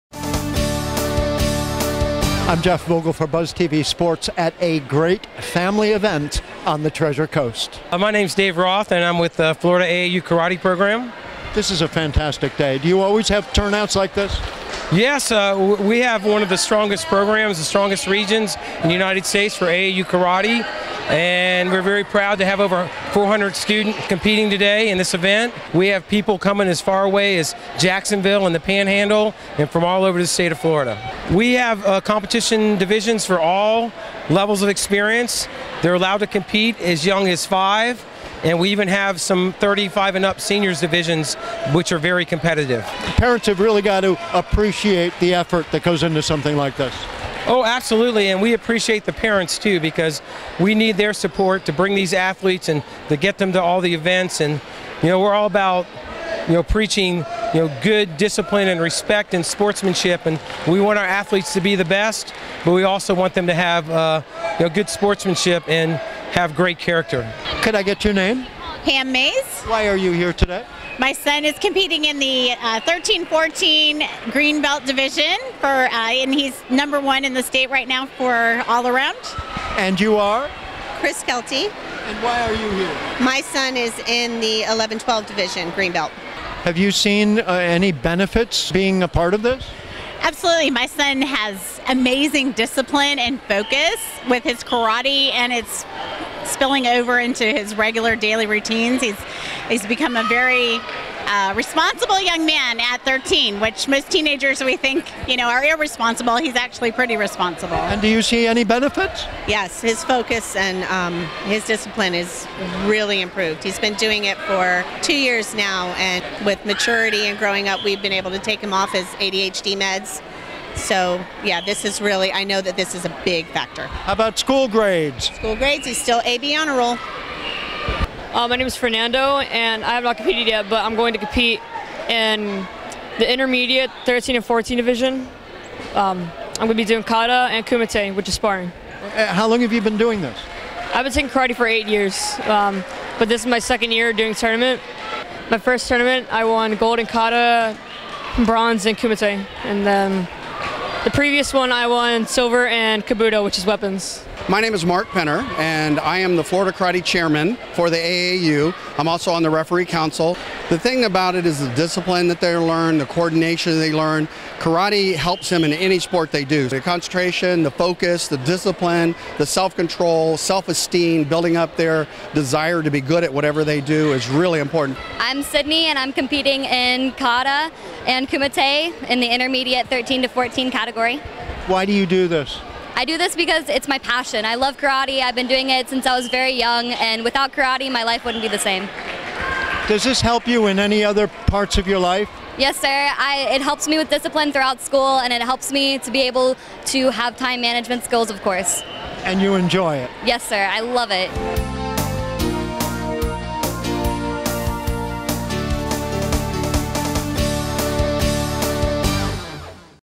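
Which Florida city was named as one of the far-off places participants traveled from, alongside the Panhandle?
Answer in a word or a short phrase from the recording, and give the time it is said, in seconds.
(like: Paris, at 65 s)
Jacksonville, at 27 s.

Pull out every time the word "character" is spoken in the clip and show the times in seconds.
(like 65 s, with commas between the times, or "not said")
66 s.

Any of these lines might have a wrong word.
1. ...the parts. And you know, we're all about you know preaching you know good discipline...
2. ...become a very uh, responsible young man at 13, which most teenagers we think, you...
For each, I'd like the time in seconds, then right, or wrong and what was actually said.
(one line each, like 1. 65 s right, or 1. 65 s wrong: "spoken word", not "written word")
1. 53 s wrong: "events", not "parts"
2. 99 s right.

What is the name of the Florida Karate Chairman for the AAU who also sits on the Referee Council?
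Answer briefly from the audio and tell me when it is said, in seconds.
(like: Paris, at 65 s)
Mark Penner, at 154 s.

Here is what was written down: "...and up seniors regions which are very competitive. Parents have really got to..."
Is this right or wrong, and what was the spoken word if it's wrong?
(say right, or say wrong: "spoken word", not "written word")
wrong: "divisions", not "regions".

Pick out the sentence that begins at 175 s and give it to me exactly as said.
I'm Sydney, and I'm competing in kata and kumite in the intermediate 13 to 14 category.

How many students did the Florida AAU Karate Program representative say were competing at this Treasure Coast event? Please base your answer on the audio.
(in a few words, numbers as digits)
over 400.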